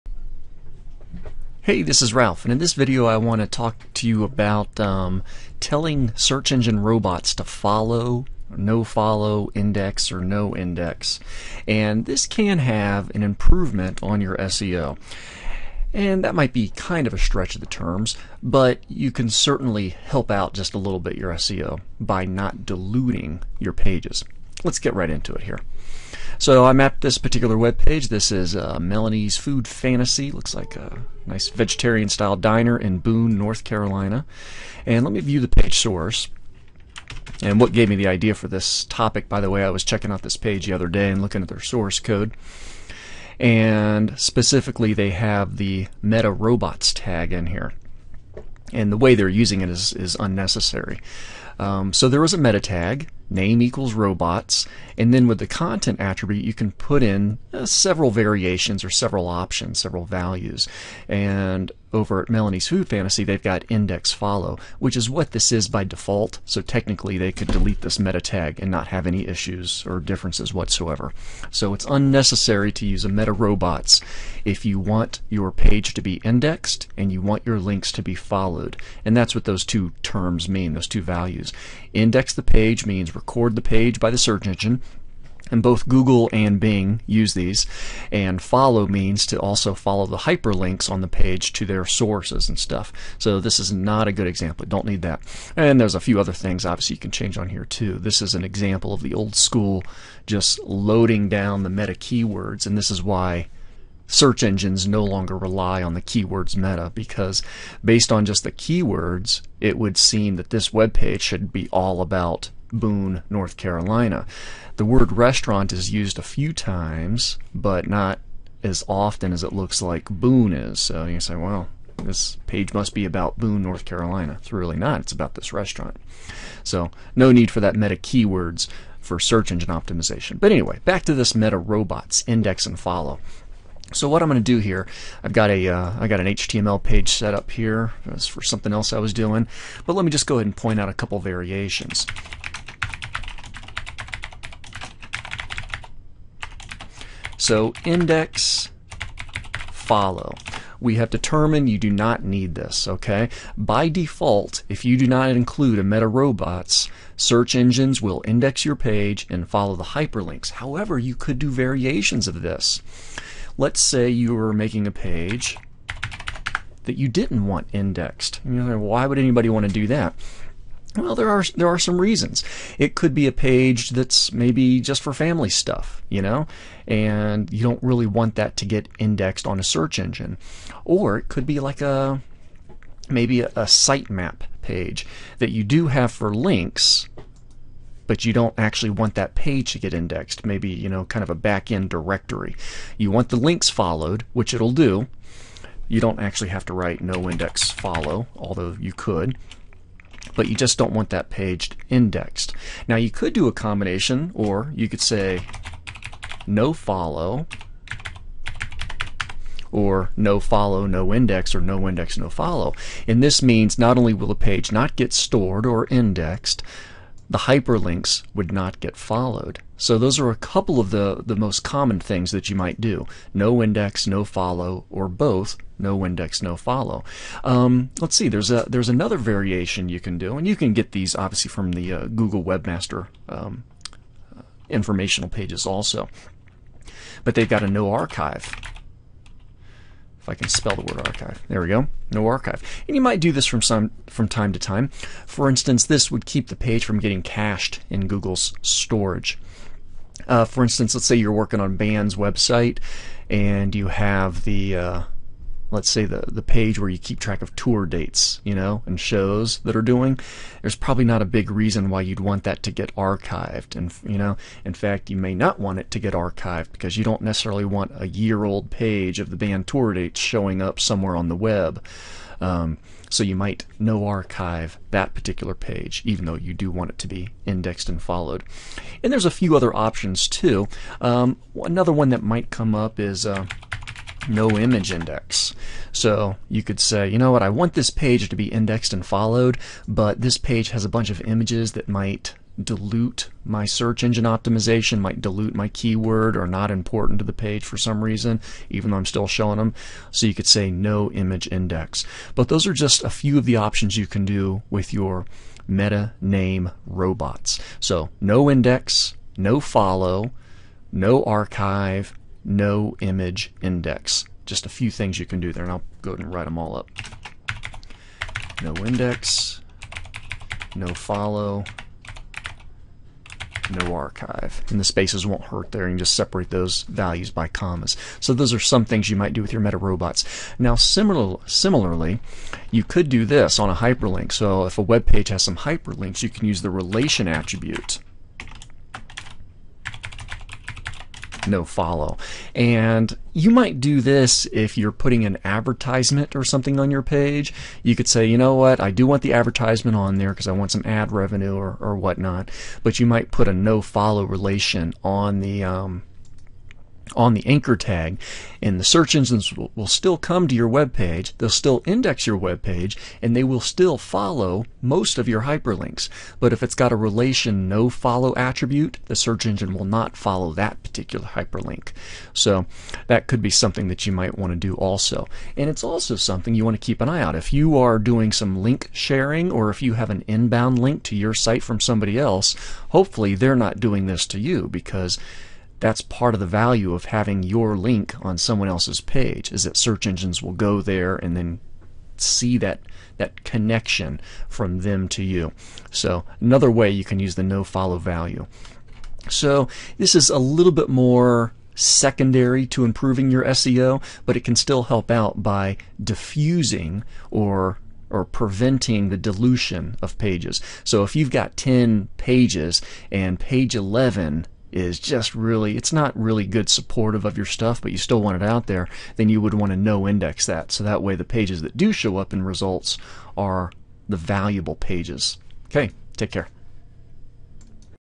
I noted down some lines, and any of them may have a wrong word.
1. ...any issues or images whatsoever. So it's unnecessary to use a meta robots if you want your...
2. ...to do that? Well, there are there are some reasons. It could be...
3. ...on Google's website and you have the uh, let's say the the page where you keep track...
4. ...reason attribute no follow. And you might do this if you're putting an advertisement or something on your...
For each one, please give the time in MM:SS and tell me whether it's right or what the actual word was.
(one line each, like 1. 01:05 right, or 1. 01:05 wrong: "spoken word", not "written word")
1. 01:09 wrong: "differences", not "images"
2. 02:49 right
3. 04:11 wrong: "Band", not "Google"
4. 05:36 wrong: "relation", not "reason".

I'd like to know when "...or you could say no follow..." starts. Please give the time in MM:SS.
03:24.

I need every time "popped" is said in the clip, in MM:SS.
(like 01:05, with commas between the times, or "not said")
not said.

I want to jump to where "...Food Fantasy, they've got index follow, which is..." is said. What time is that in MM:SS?
01:02.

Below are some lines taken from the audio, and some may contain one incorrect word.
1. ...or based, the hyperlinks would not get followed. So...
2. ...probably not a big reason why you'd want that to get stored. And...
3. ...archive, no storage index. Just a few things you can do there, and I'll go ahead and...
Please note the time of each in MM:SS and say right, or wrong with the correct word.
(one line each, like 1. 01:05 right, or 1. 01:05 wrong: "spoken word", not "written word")
1. 03:35 wrong: "indexed", not "based"
2. 04:20 wrong: "archived", not "stored"
3. 05:11 wrong: "image", not "storage".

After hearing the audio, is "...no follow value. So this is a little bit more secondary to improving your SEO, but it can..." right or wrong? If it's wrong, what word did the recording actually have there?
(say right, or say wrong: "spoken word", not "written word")
right.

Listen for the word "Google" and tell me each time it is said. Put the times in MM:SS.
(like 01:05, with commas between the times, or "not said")
01:25, 03:52, 04:08.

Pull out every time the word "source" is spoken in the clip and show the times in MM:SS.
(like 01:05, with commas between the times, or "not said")
00:35, 00:41, 01:31.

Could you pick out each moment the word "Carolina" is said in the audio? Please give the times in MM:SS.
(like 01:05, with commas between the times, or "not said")
00:33, 01:53, 02:03.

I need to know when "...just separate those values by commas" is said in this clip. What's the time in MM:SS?
05:25.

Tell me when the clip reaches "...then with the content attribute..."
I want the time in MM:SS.
00:55.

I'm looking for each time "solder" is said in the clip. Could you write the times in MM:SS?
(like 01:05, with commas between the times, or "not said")
not said.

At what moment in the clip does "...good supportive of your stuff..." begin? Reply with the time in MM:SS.
06:56.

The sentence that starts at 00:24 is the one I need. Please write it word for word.
Let's get right into it here.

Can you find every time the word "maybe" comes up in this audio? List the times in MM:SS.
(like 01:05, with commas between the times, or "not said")
02:54, 03:03, 03:10.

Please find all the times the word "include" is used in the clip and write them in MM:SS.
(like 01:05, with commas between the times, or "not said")
02:35.